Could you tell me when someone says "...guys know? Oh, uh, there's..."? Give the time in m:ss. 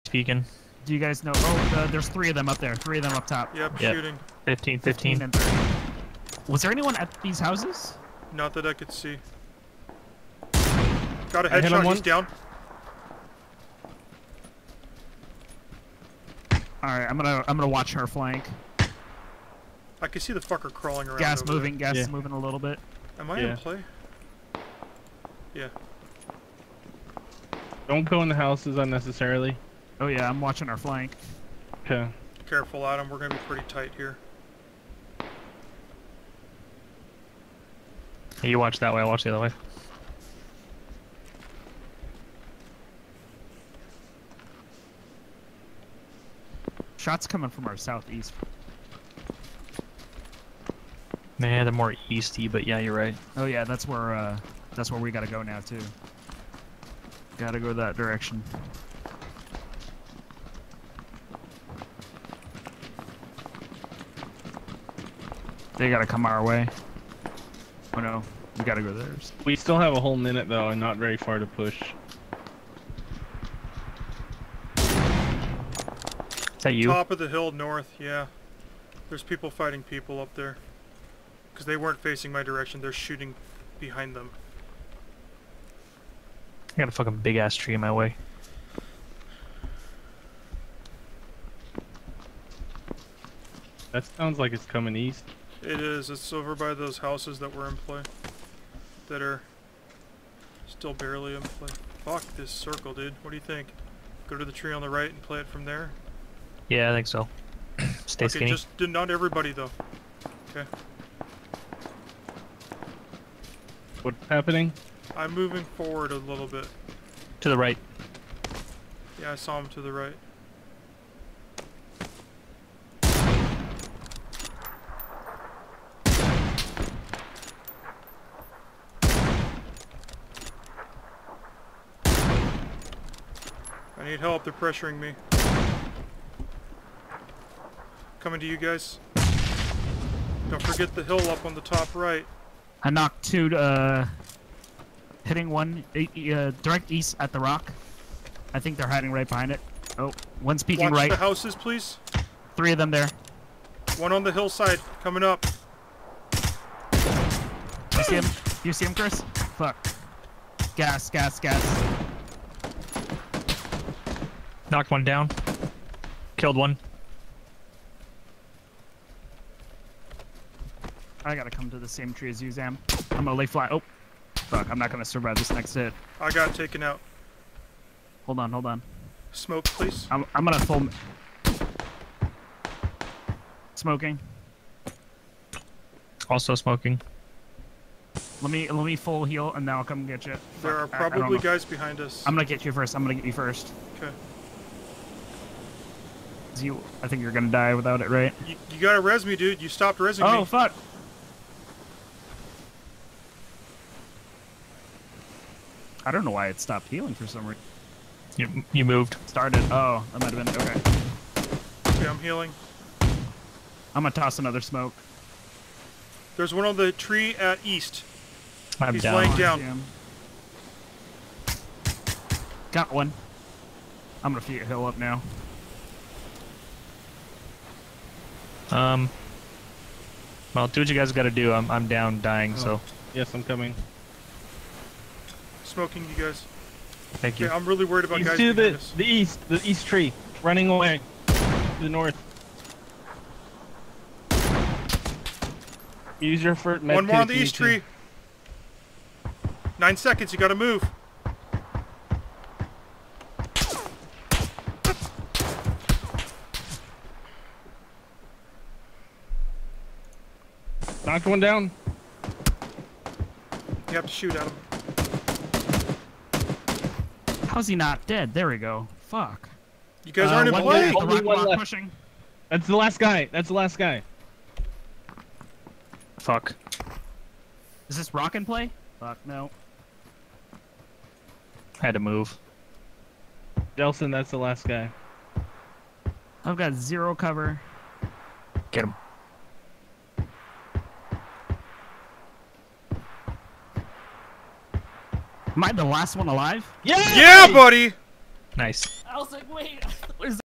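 0:00.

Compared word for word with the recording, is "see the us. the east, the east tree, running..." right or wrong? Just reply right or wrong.
right.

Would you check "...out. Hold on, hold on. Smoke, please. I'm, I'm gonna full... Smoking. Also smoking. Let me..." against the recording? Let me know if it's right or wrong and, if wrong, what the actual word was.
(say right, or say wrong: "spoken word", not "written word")
right.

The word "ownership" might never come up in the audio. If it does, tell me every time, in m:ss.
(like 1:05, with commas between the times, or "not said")
not said.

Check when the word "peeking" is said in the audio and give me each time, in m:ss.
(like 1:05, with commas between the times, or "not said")
0:00, 2:30.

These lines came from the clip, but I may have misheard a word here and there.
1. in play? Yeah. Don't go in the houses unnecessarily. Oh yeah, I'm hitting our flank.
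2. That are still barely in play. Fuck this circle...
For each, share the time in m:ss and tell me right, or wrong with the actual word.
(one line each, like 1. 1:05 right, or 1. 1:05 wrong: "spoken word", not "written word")
1. 0:23 wrong: "watching", not "hitting"
2. 1:39 right.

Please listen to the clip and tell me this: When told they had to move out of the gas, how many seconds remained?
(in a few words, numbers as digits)
9.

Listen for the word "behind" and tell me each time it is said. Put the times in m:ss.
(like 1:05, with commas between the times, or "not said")
1:23, 2:29, 3:11.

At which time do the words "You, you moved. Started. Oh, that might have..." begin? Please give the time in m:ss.
3:28.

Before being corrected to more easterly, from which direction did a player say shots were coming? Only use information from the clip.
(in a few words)
Southeast.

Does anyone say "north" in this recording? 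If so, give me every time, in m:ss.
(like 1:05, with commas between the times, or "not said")
1:17, 4:01.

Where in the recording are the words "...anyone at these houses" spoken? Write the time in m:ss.
0:06.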